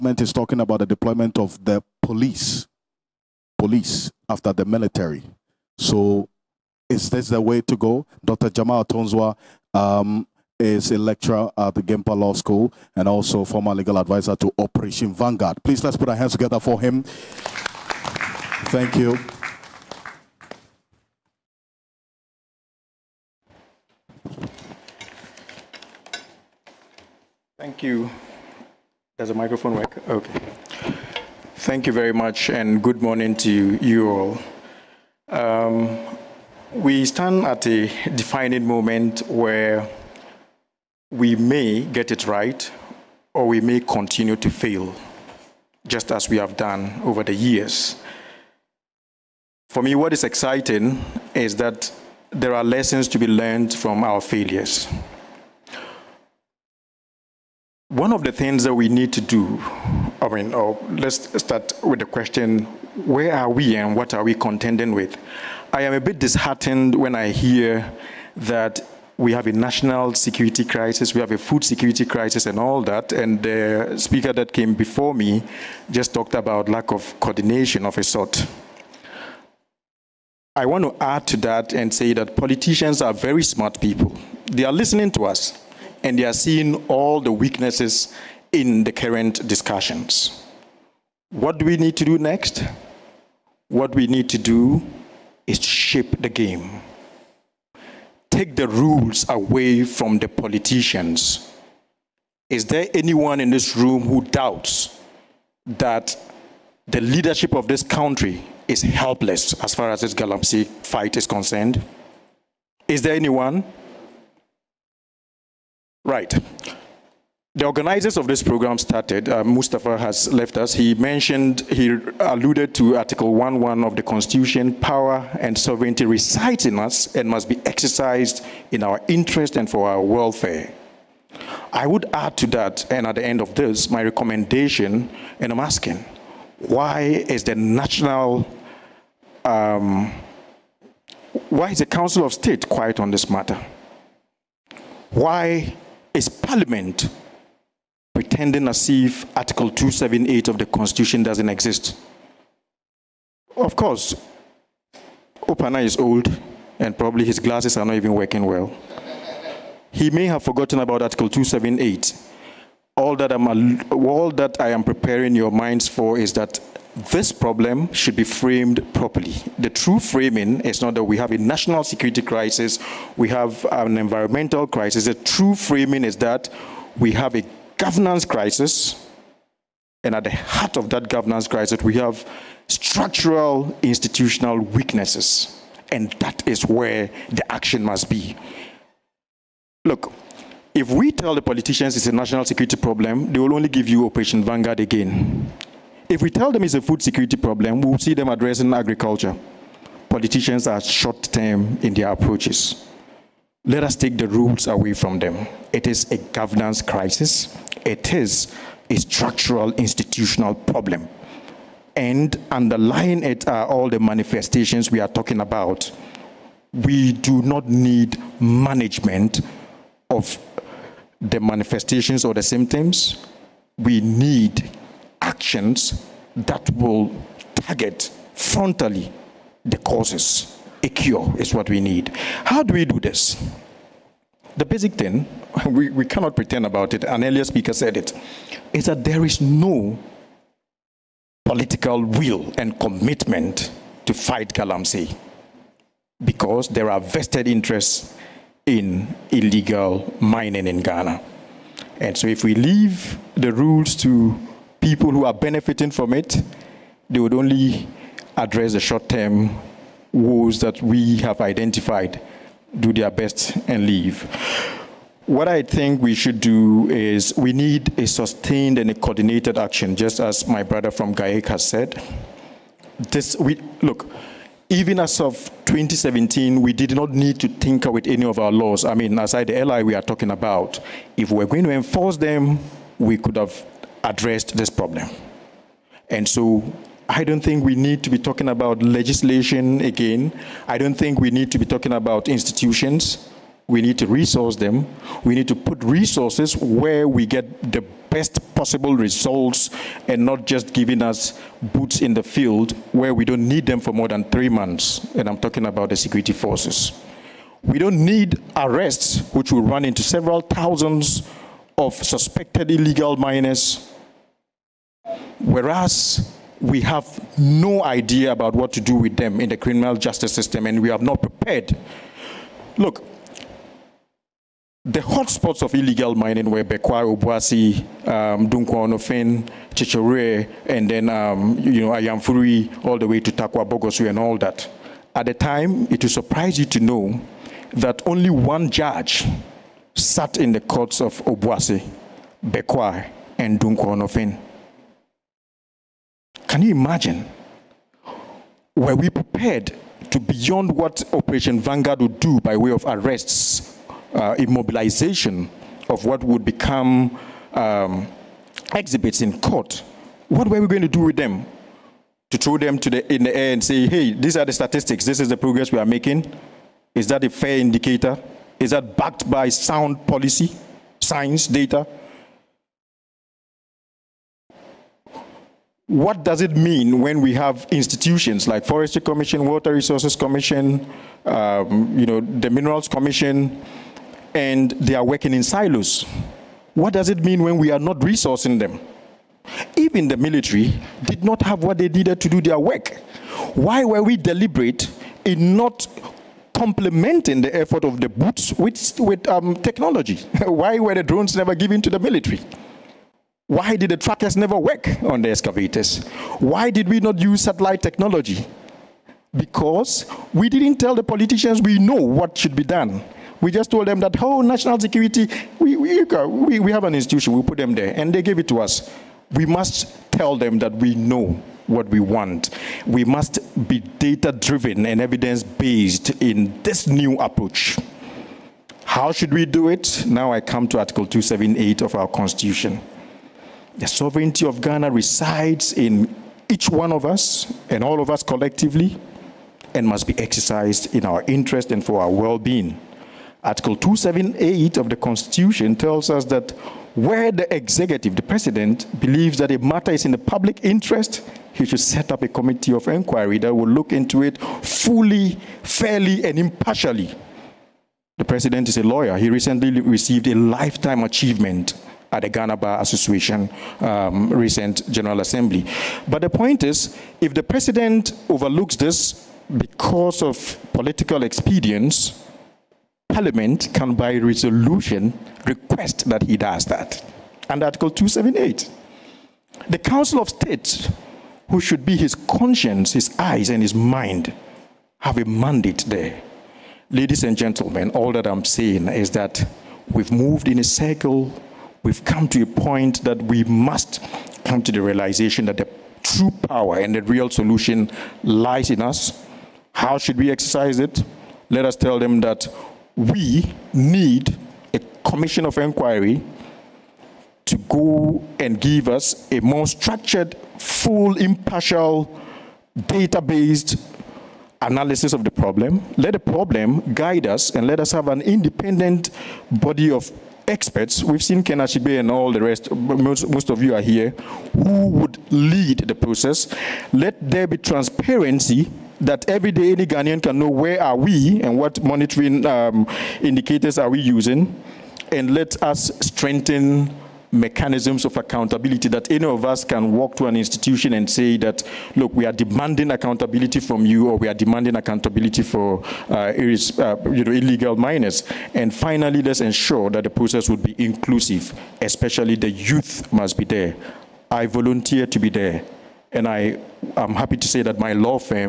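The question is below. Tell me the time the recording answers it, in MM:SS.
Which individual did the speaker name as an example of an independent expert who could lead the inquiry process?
08:41.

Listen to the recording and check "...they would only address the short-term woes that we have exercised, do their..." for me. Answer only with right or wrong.
wrong.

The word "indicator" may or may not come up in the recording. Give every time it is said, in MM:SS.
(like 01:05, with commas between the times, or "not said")
06:07, 08:53.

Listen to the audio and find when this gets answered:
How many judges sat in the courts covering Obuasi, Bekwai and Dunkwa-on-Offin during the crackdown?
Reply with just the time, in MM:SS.
05:38.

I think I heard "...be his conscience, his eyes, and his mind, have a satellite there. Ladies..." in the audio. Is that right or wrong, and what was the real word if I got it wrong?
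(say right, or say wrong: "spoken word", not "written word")
wrong: "mandate", not "satellite".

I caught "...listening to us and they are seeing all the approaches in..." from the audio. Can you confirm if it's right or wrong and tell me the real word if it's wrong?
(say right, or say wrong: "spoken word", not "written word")
wrong: "weaknesses", not "approaches".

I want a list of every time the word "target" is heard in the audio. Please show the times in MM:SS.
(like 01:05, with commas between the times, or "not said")
03:47.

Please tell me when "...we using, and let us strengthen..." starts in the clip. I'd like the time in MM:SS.
08:53.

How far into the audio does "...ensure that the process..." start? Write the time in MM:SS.
09:09.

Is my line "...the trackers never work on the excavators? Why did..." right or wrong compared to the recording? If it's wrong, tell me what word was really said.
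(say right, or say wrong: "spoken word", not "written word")
right.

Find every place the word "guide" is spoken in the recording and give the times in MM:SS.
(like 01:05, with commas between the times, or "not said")
08:36.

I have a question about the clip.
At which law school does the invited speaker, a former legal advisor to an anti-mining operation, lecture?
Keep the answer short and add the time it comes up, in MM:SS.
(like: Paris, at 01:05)
GIMPA Law School, at 00:11.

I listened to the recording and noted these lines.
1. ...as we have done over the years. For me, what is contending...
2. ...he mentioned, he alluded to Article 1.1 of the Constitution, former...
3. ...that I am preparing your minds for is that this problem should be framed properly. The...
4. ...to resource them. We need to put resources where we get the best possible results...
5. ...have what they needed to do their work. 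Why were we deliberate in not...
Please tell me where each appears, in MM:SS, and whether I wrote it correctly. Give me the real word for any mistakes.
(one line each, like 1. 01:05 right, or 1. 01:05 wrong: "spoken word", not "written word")
1. 00:46 wrong: "exciting", not "contending"
2. 02:00 wrong: "power", not "former"
3. 02:44 right
4. 04:53 right
5. 06:31 right.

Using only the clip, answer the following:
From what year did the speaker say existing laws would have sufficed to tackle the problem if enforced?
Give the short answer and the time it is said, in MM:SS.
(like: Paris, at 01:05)
2017, at 04:35.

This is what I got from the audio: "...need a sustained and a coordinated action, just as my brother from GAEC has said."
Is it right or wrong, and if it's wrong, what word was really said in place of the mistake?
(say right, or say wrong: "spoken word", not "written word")
right.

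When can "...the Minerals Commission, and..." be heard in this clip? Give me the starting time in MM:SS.
06:22.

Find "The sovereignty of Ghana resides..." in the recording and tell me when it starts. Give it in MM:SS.
07:13.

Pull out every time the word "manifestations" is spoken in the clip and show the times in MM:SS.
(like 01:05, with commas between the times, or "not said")
03:33, 03:41.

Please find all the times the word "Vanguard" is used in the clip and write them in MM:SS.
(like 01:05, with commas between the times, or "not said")
00:15, 03:14, 05:51.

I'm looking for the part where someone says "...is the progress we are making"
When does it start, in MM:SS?
06:05.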